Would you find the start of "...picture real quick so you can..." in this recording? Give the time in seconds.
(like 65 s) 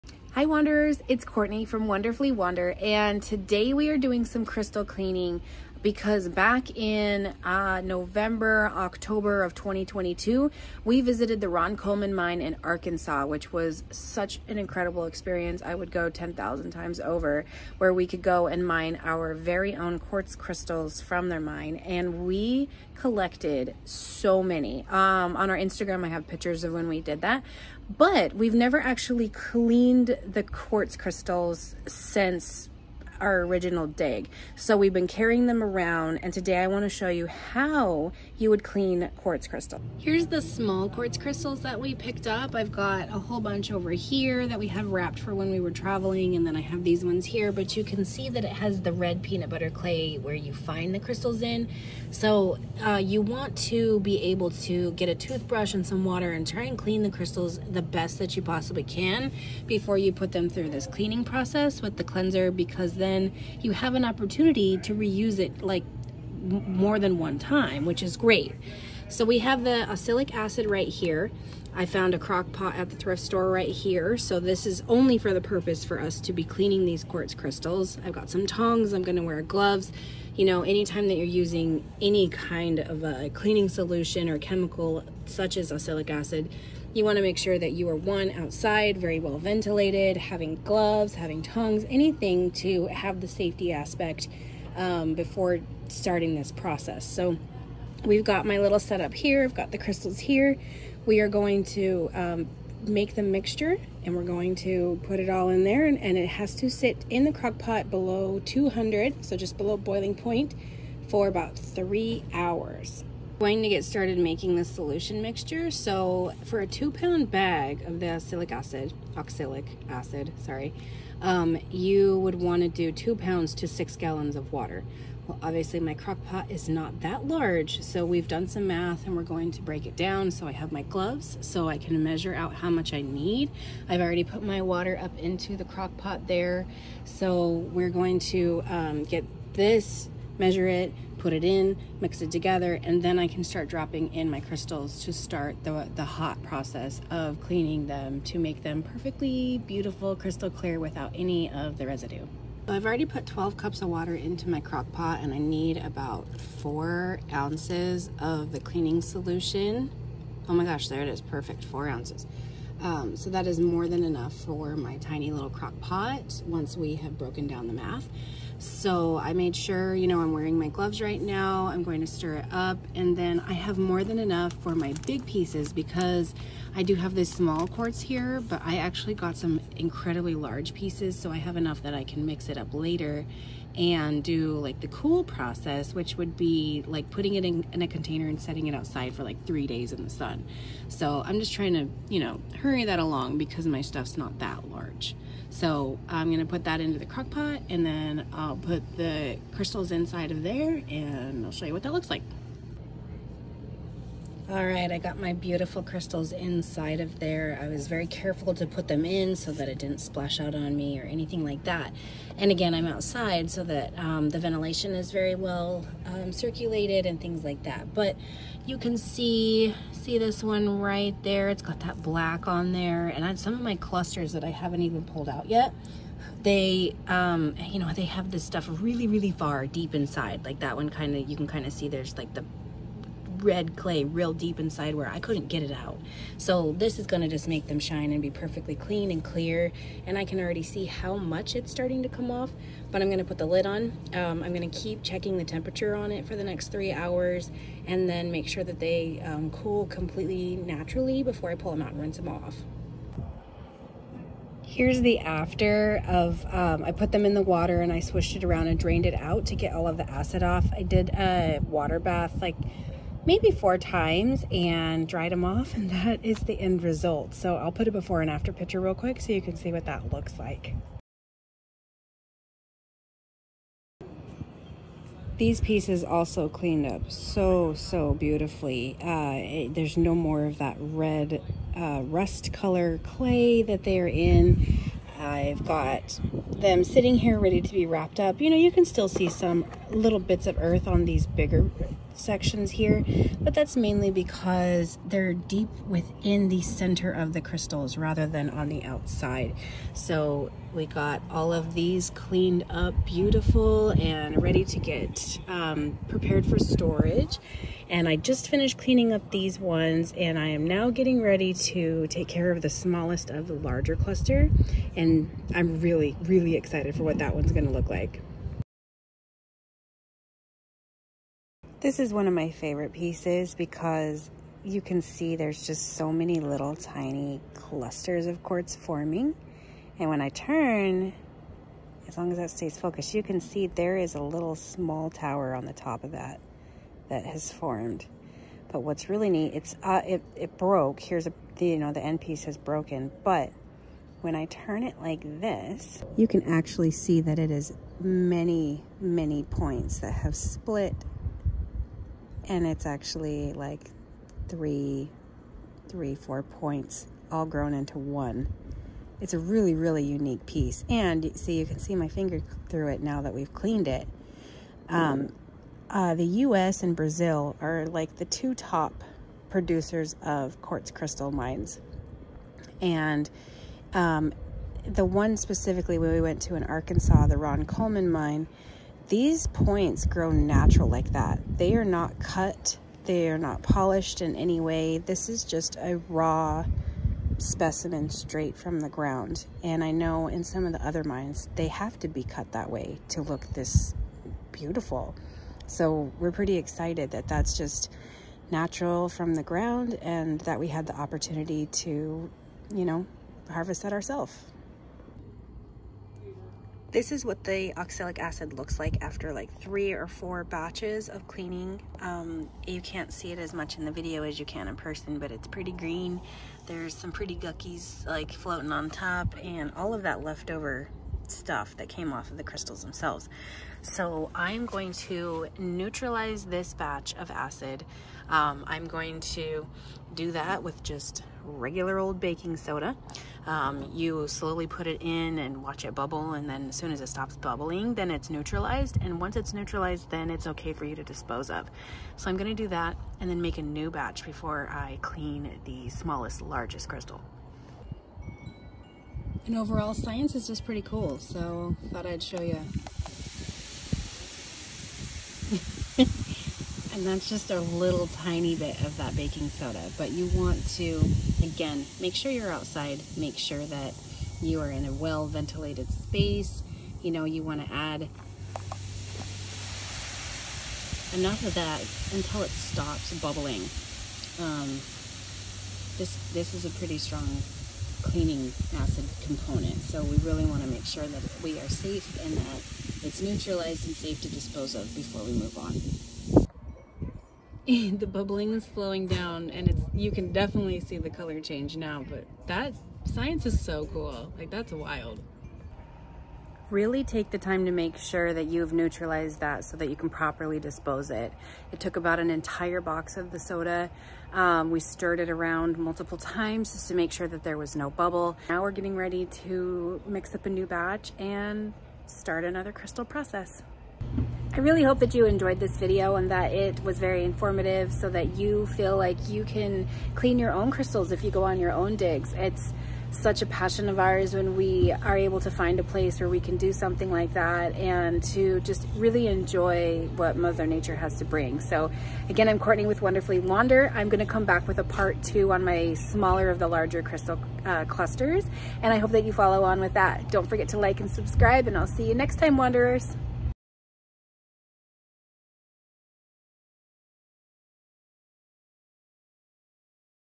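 268 s.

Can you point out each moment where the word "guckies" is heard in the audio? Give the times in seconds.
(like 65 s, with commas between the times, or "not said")
417 s.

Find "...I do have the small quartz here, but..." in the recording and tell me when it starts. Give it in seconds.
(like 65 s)
176 s.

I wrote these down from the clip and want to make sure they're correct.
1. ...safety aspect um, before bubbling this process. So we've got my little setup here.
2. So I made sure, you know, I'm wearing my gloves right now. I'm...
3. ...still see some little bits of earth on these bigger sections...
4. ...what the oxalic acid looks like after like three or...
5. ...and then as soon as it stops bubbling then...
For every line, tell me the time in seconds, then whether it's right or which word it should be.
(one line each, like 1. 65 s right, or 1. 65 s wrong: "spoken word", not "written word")
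1. 93 s wrong: "starting", not "bubbling"
2. 168 s right
3. 288 s right
4. 407 s right
5. 436 s right.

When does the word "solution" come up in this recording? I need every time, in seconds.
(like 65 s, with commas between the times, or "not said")
83 s, 114 s, 158 s.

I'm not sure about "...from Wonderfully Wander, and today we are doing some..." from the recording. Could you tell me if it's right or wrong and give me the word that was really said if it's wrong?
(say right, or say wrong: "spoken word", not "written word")
right.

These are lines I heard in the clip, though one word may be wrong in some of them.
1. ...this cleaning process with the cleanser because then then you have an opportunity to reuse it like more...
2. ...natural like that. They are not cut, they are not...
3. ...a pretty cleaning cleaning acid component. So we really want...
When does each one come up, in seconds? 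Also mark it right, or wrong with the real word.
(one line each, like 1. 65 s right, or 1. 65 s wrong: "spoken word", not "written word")
1. 60 s right
2. 380 s right
3. 476 s wrong: "strong", not "cleaning".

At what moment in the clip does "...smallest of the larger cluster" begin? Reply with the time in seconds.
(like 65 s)
312 s.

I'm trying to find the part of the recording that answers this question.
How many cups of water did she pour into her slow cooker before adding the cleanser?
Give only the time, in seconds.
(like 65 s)
153 s.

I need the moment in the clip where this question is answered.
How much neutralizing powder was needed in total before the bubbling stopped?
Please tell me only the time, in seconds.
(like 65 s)
502 s.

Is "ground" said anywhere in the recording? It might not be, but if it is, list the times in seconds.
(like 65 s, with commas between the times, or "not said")
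388 s, 399 s.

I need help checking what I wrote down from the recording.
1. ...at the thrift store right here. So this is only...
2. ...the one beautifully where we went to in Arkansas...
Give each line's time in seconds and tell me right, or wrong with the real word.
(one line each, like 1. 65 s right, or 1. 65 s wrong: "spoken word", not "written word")
1. 72 s right
2. 374 s wrong: "specifically", not "beautifully".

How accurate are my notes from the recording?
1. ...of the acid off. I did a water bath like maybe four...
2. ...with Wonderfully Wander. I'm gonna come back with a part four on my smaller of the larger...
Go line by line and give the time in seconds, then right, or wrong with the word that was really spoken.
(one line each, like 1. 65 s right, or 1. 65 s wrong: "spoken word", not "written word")
1. 259 s right
2. 532 s wrong: "two", not "four".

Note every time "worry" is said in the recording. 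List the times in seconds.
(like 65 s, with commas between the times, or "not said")
not said.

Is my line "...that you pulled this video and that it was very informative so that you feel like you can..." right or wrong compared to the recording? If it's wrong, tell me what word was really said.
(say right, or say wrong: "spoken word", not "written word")
wrong: "enjoyed", not "pulled".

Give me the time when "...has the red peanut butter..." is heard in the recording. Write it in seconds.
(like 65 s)
48 s.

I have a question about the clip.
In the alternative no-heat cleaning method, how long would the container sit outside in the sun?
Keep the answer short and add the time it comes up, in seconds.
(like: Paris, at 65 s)
three days, at 189 s.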